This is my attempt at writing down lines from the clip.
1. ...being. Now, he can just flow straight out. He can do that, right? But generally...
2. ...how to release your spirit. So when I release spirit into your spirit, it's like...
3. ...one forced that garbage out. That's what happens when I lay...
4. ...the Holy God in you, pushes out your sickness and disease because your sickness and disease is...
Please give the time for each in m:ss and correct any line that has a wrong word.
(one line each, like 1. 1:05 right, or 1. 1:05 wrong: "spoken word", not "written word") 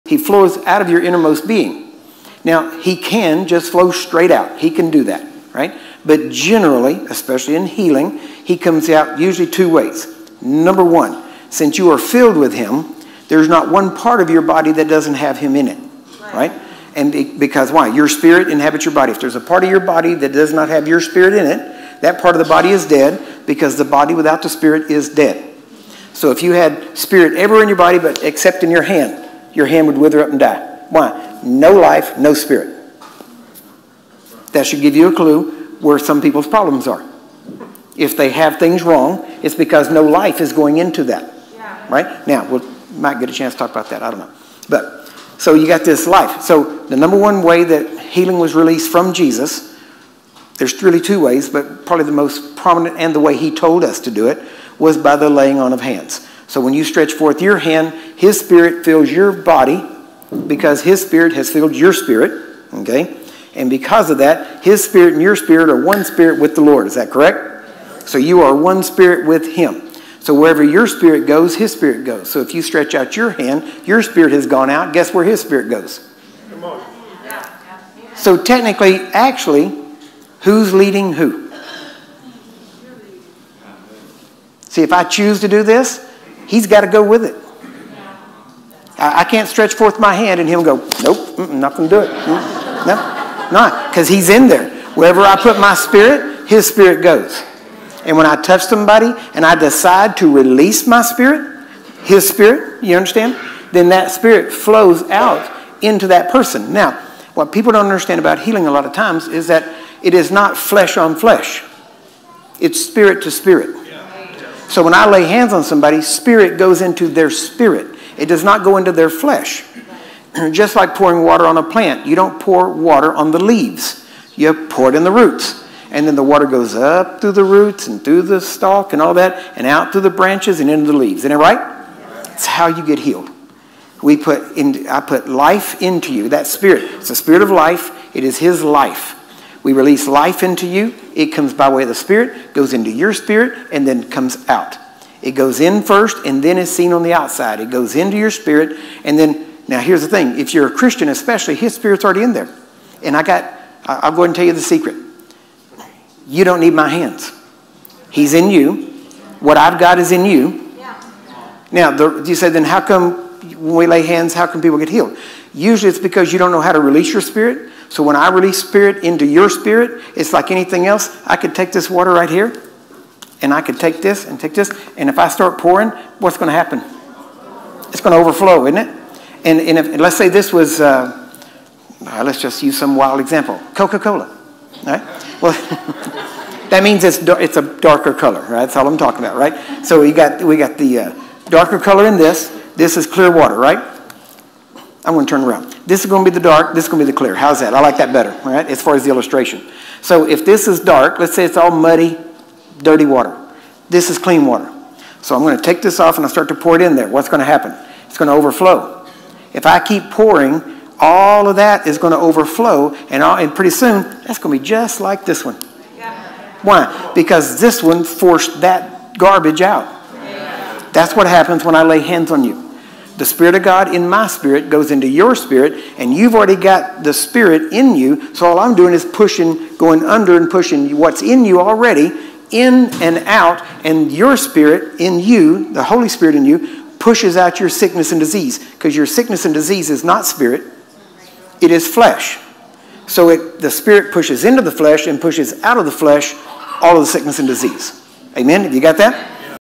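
1. 0:01 right
2. 2:46 right
3. 3:37 right
4. 3:55 wrong: "Spirit", not "God".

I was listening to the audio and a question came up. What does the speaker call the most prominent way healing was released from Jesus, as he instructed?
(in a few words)
Laying on of hands.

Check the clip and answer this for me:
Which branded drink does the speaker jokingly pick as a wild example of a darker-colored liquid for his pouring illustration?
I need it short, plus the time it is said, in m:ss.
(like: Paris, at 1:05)
Coca Cola, at 3:03.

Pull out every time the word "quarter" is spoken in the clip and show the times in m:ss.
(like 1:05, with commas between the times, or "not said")
not said.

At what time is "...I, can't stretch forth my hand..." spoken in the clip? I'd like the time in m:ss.
1:29.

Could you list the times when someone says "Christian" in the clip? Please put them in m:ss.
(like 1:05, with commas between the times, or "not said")
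2:30.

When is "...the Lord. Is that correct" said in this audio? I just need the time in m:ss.
1:06.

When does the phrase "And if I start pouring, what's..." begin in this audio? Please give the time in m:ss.
2:54.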